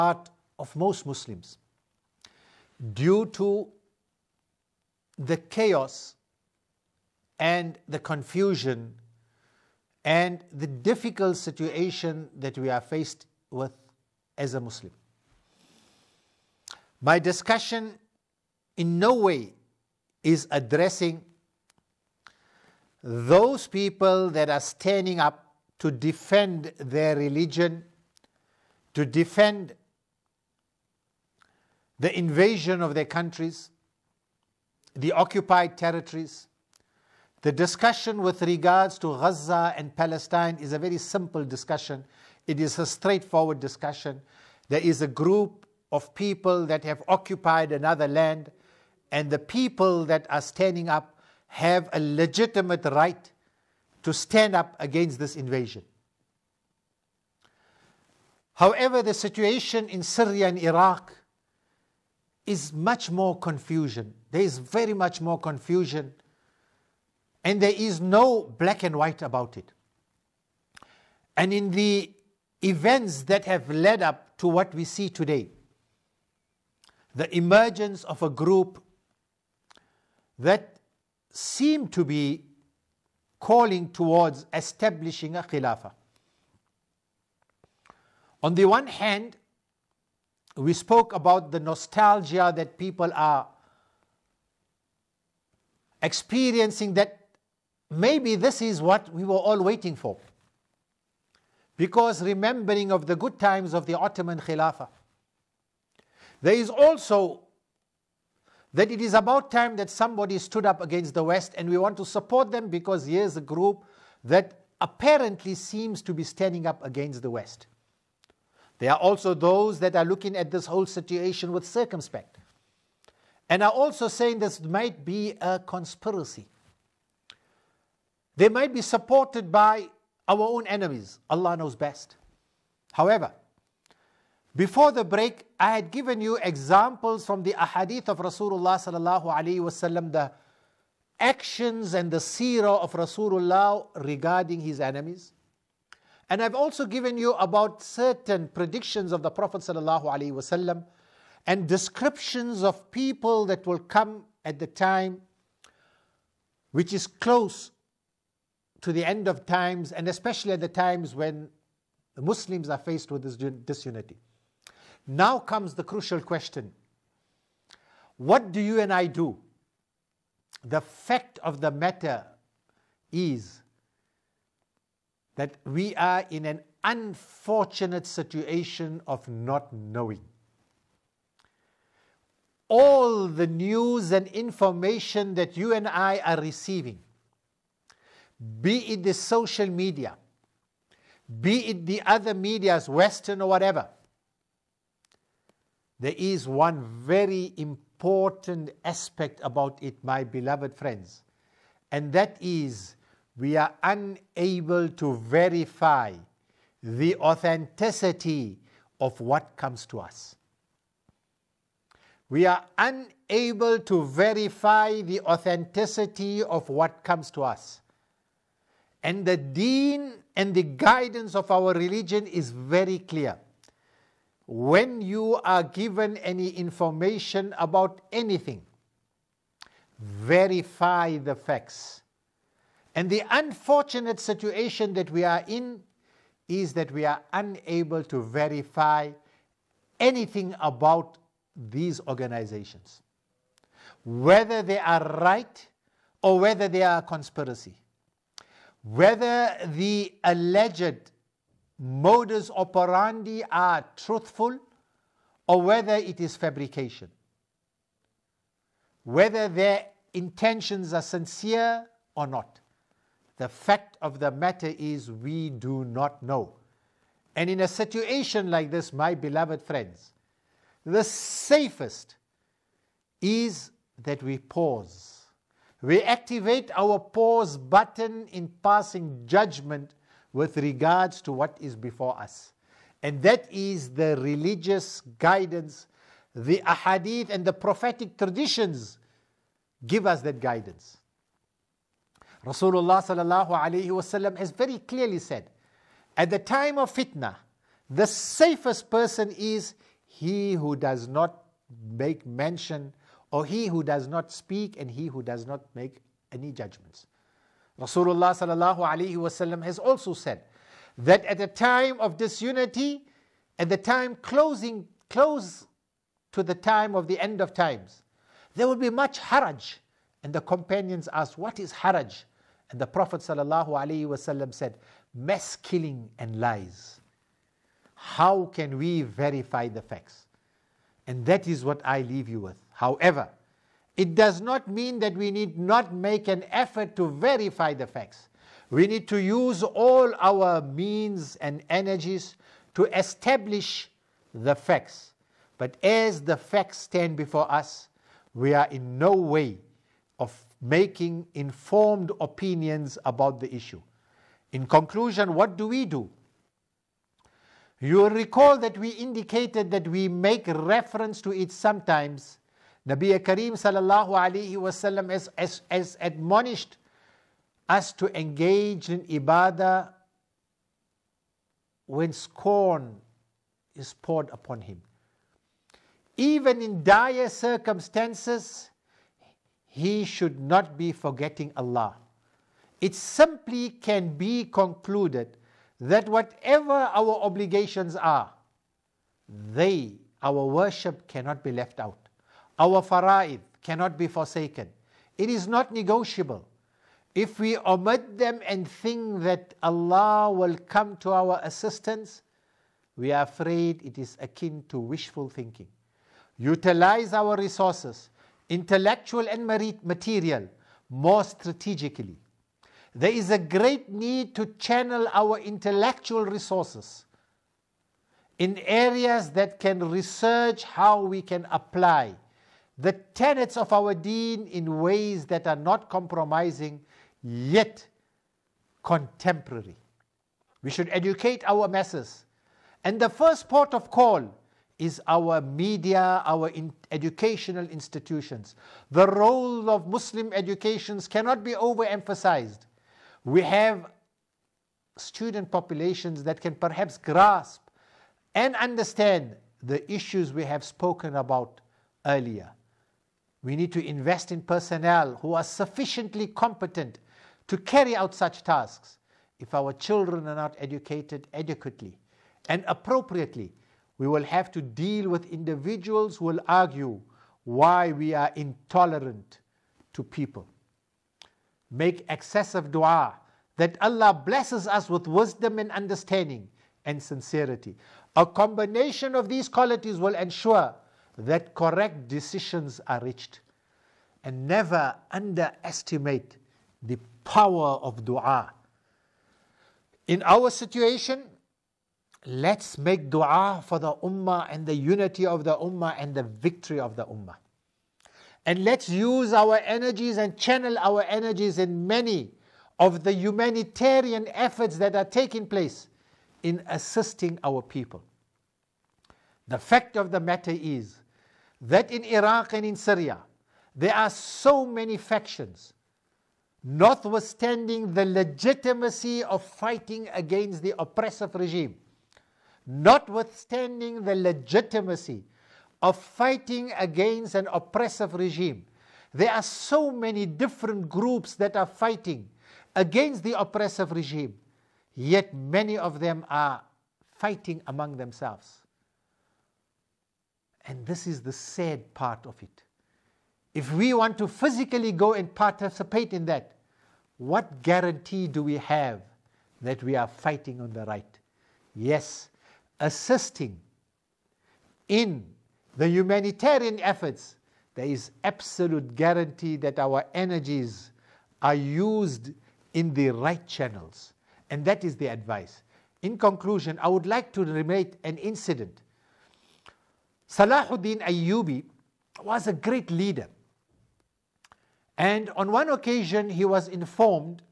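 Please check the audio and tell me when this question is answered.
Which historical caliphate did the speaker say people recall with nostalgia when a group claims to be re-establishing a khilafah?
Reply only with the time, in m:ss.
1:43.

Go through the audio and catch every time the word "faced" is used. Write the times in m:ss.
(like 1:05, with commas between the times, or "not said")
0:12, 2:42.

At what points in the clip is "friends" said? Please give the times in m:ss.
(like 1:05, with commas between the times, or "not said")
3:20, 4:29.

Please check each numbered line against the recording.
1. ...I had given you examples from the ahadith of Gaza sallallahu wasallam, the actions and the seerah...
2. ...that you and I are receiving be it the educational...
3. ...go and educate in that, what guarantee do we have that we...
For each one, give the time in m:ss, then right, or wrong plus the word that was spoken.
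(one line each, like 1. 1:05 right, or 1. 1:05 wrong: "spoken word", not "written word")
1. 2:15 wrong: "Rasulullah", not "Gaza"
2. 3:05 wrong: "social", not "educational"
3. 9:04 wrong: "participate", not "educate".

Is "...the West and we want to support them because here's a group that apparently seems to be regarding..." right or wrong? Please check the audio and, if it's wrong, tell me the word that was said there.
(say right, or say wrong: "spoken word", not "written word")
wrong: "standing", not "regarding".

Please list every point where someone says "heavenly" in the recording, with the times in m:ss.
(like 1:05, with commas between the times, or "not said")
not said.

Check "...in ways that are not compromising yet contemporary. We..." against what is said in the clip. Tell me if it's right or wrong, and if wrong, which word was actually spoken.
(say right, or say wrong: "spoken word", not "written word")
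right.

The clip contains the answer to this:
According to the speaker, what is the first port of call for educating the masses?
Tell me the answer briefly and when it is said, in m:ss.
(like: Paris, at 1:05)
our media, at 7:15.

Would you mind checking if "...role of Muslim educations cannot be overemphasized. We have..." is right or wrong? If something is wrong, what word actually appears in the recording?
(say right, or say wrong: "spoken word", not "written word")
right.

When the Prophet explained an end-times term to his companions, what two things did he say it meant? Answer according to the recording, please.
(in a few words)
Mass killing and lies.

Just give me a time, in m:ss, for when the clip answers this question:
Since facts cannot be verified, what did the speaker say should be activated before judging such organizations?
4:36.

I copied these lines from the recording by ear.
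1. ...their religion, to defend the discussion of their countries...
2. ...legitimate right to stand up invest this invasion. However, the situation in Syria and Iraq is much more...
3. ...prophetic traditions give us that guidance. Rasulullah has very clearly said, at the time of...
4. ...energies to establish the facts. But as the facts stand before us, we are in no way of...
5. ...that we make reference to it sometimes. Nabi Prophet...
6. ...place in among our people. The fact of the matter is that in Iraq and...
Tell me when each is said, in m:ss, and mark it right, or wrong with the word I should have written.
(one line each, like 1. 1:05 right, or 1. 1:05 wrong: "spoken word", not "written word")
1. 0:26 wrong: "invasion", not "discussion"
2. 0:51 wrong: "against", not "invest"
3. 4:47 right
4. 5:41 right
5. 5:59 wrong: "Karim", not "Prophet"
6. 8:25 wrong: "assisting", not "among".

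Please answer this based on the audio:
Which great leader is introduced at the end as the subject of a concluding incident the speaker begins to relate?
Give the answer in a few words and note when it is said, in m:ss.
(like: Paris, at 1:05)
Salahuddin Ayyubi, at 9:30.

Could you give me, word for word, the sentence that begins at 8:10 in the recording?
In our situation, let's make dua for the ummah and the unity of the ummah and the victory of the ummah.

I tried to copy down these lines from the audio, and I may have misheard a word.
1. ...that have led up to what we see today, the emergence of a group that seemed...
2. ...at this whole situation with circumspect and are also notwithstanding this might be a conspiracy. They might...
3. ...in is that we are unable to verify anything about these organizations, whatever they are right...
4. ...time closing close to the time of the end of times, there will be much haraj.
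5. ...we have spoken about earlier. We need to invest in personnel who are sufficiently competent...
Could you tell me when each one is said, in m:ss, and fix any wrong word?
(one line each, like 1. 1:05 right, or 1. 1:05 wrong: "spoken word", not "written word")
1. 1:13 right
2. 2:00 wrong: "saying", not "notwithstanding"
3. 3:55 wrong: "whether", not "whatever"
4. 5:13 right
5. 7:30 right.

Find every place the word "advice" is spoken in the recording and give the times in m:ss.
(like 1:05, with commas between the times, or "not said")
9:25.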